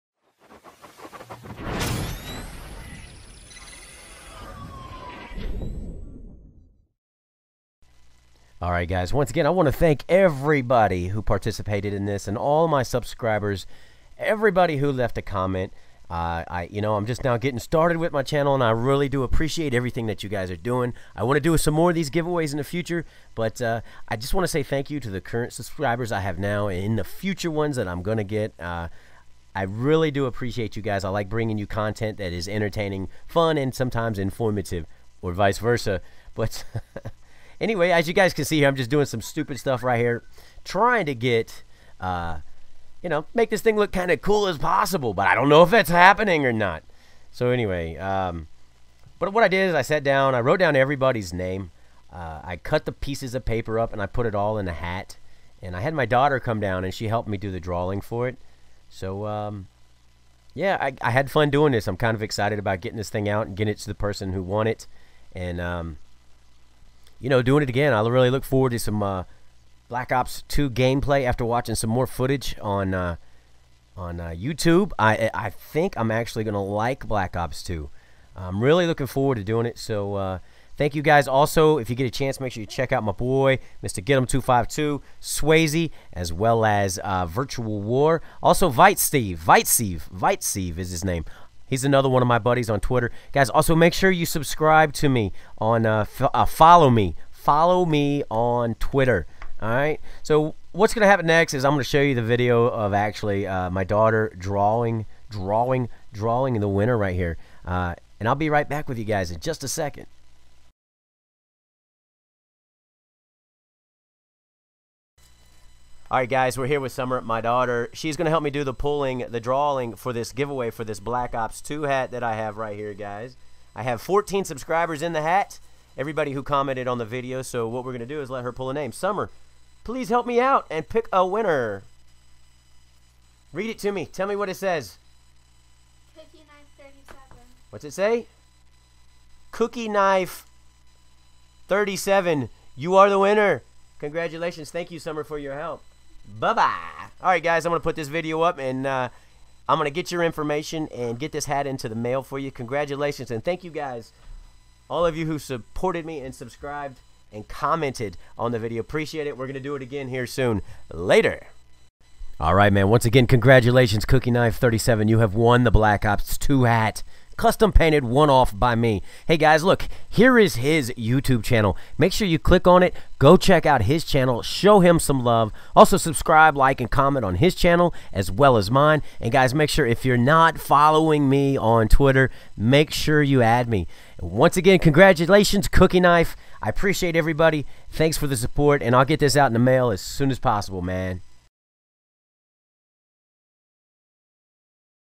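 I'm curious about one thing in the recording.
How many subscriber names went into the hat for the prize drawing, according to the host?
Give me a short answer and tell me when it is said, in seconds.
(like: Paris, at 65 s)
14, at 124 s.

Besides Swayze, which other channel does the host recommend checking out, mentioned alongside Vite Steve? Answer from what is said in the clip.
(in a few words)
Virtual War.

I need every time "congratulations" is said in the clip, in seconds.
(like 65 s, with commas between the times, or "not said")
143 s, 152 s, 163 s, 184 s.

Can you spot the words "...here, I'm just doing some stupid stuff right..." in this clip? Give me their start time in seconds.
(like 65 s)
38 s.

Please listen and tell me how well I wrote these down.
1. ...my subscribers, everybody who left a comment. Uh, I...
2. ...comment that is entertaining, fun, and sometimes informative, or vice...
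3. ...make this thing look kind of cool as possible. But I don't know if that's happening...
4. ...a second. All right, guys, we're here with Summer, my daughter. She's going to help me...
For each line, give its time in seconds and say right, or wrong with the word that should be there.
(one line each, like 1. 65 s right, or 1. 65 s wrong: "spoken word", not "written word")
1. 12 s right
2. 31 s wrong: "content", not "comment"
3. 43 s right
4. 109 s right.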